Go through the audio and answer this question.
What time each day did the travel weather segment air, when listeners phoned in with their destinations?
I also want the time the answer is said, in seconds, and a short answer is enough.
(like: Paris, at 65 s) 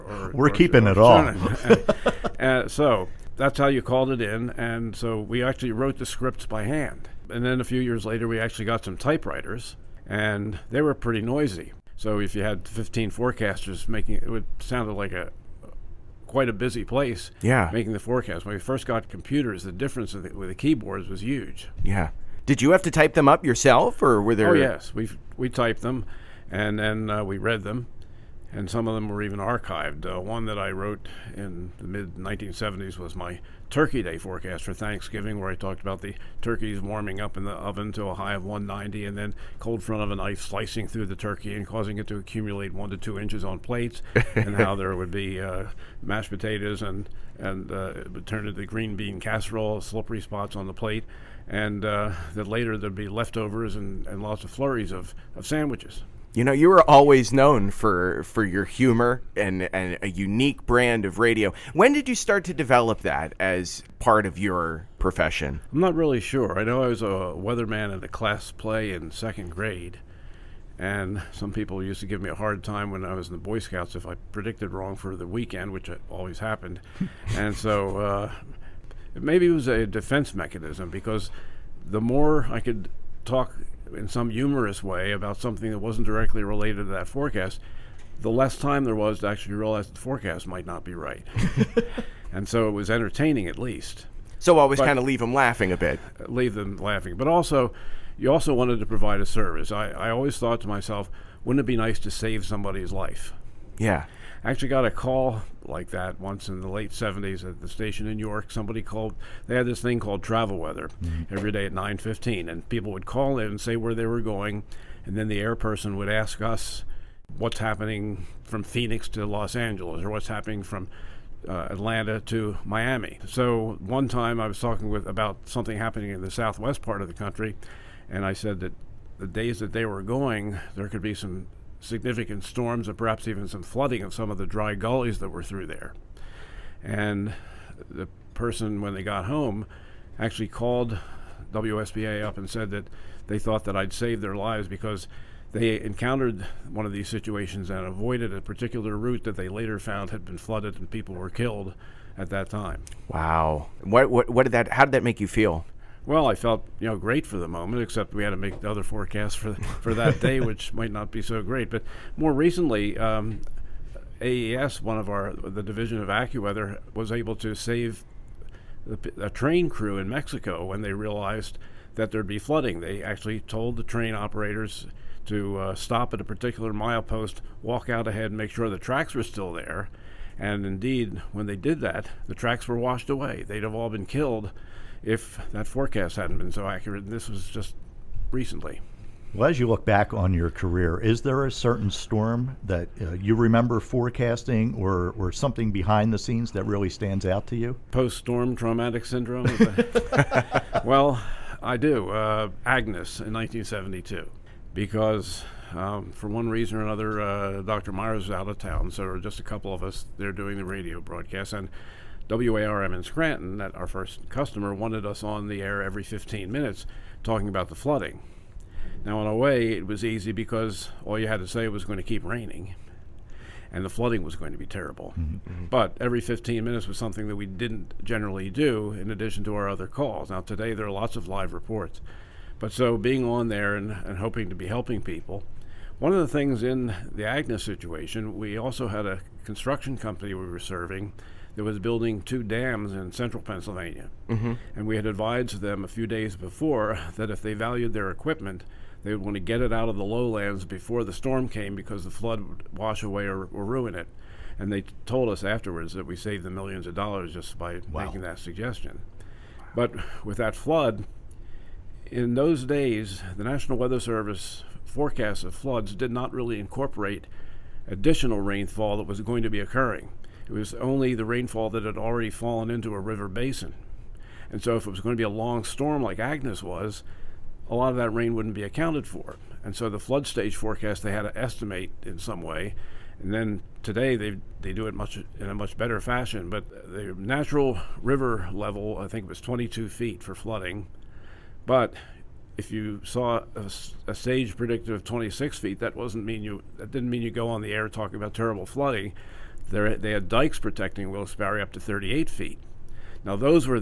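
9:15, at 111 s.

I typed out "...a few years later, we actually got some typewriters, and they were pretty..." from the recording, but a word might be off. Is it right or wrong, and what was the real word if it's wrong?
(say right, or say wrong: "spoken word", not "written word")
right.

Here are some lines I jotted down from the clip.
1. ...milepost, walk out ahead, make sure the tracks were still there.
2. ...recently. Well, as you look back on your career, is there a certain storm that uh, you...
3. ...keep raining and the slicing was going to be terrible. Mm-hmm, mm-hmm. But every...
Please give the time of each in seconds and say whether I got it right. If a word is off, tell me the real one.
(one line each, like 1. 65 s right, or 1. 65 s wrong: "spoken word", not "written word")
1. 176 s right
2. 188 s right
3. 222 s wrong: "flooding", not "slicing".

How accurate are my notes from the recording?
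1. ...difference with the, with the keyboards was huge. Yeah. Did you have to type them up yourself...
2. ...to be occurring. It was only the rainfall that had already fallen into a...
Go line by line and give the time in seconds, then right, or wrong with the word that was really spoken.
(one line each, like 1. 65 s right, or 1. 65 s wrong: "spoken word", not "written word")
1. 19 s right
2. 269 s right.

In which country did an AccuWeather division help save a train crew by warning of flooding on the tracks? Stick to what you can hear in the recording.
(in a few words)
Mexico.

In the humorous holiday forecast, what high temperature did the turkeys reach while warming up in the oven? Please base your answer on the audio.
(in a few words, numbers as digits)
190.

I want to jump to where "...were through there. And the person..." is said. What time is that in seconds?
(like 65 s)
135 s.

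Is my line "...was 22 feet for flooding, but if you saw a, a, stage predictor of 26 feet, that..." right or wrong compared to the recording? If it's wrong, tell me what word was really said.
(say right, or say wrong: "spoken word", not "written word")
right.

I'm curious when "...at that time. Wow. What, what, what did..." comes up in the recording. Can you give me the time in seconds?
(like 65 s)
152 s.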